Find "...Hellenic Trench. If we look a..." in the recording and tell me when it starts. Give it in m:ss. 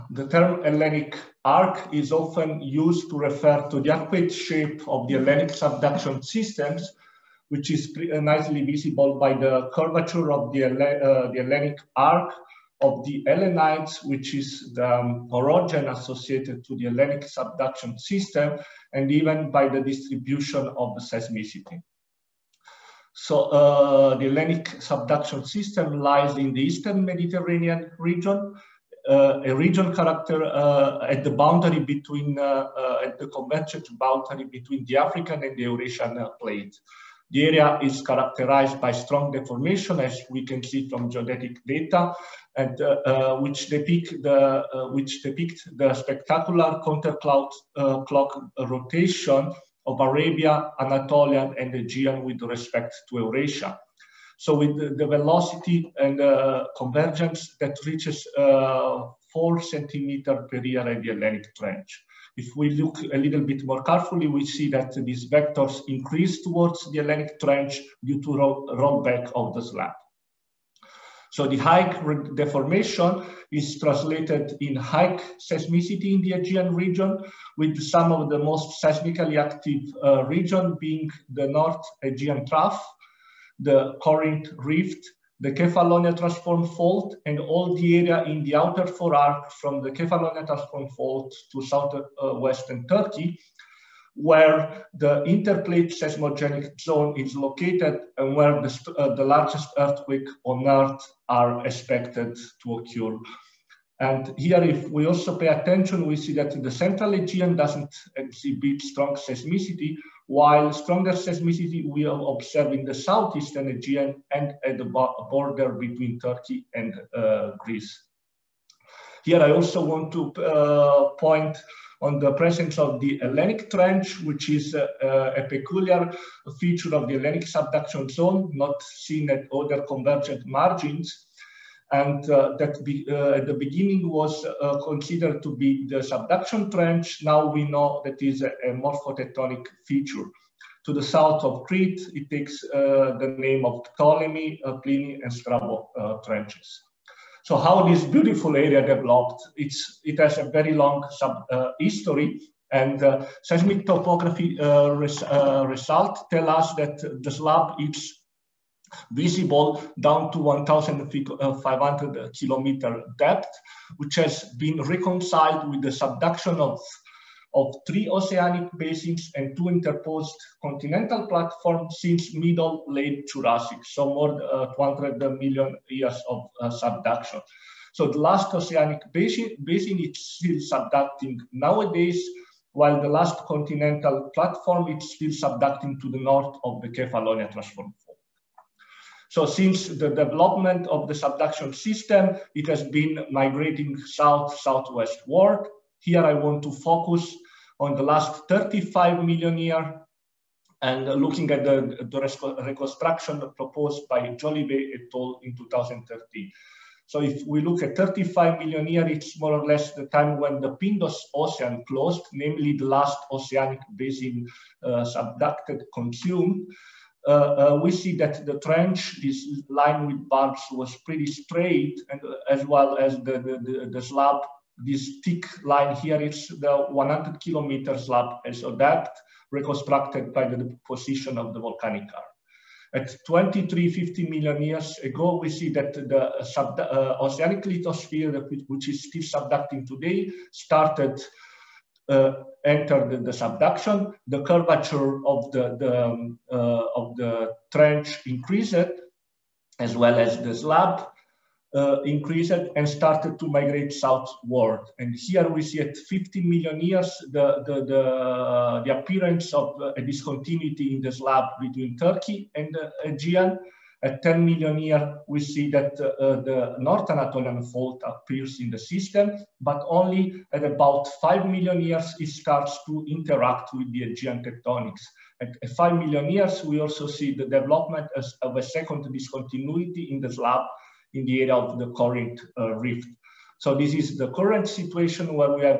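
1:01.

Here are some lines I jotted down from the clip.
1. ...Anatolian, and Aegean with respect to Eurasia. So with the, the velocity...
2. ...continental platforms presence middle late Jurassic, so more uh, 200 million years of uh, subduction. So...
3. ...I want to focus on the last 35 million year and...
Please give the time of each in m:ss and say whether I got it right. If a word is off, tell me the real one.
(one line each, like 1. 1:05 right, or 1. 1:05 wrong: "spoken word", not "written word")
1. 0:50 right
2. 2:50 wrong: "since", not "presence"
3. 3:16 right.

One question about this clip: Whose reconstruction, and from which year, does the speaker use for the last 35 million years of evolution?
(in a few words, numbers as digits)
Jolivet et al. 2013.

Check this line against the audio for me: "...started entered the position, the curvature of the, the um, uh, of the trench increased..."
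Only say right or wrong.
wrong.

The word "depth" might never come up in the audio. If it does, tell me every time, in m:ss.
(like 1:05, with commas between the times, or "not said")
2:43, 3:48.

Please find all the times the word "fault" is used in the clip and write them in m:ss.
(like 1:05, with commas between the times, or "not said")
1:26, 1:30, 4:27.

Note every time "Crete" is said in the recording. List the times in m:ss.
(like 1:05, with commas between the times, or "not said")
2:21.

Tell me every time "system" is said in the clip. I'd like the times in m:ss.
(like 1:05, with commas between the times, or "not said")
0:06, 0:17, 0:25, 3:11, 4:28.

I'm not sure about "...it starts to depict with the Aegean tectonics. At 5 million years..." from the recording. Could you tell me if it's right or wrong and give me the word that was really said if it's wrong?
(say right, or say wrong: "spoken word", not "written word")
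wrong: "interact", not "depict".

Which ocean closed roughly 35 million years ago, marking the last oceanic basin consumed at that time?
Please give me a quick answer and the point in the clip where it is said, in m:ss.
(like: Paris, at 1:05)
Pindus Ocean, at 3:30.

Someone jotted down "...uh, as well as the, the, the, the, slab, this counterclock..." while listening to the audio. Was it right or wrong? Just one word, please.
wrong.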